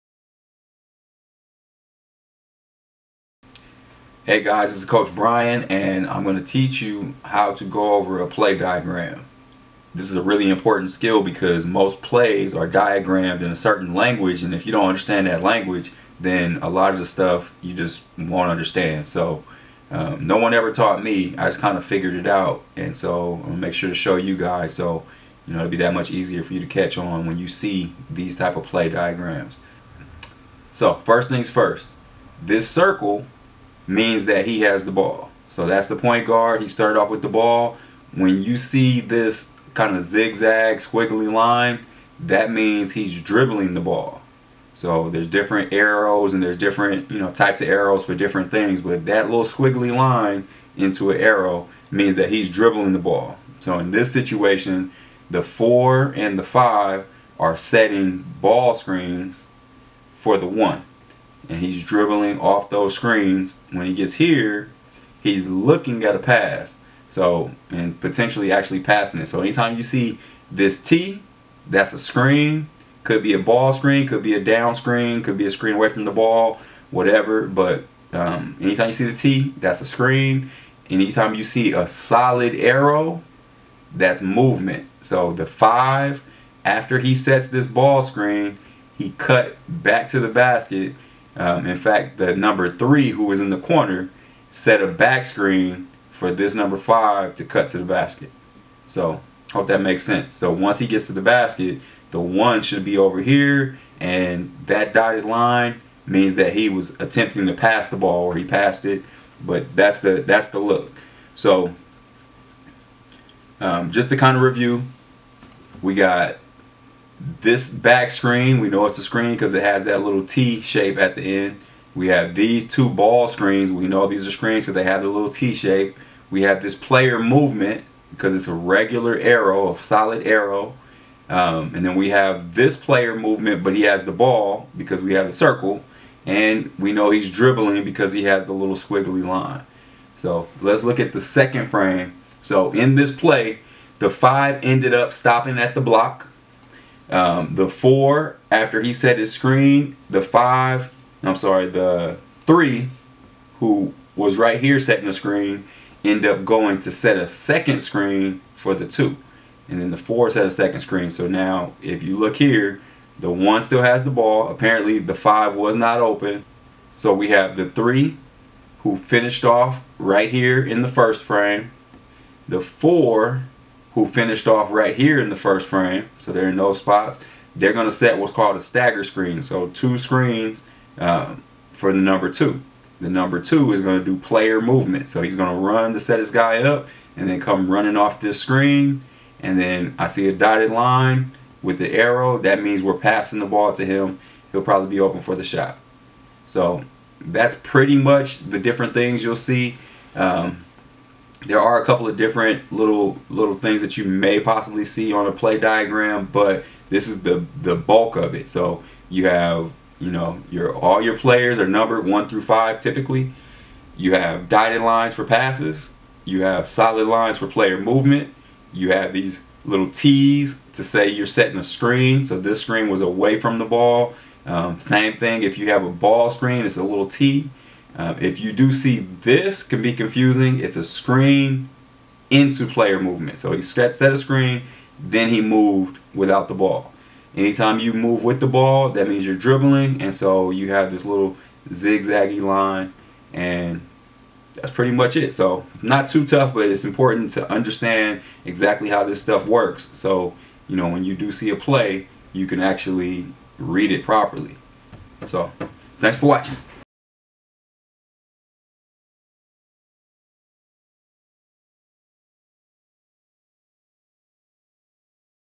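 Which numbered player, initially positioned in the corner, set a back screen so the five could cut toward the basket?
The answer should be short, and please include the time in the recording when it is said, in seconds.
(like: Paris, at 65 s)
Number three, at 92 s.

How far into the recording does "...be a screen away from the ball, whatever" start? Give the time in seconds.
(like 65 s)
75 s.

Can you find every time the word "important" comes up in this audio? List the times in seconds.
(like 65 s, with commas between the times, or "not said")
10 s, 246 s.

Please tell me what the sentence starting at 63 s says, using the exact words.
When he gets here, he's looking at a pass.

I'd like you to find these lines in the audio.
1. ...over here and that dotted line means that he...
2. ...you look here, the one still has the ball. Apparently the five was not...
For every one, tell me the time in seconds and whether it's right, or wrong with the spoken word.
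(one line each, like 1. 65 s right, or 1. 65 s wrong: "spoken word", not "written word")
1. 102 s right
2. 162 s right.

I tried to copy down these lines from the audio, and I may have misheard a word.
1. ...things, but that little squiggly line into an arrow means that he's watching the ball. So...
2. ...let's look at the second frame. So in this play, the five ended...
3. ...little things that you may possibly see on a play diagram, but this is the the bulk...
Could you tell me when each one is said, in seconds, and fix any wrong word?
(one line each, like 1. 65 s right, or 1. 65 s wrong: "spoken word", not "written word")
1. 48 s wrong: "dribbling", not "watching"
2. 140 s right
3. 203 s right.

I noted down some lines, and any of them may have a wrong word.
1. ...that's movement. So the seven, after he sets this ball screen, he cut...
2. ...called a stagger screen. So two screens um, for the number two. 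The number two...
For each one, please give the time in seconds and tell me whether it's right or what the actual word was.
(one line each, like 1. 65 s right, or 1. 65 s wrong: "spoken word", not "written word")
1. 83 s wrong: "five", not "seven"
2. 178 s right.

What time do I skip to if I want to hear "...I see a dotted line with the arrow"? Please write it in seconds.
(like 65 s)
189 s.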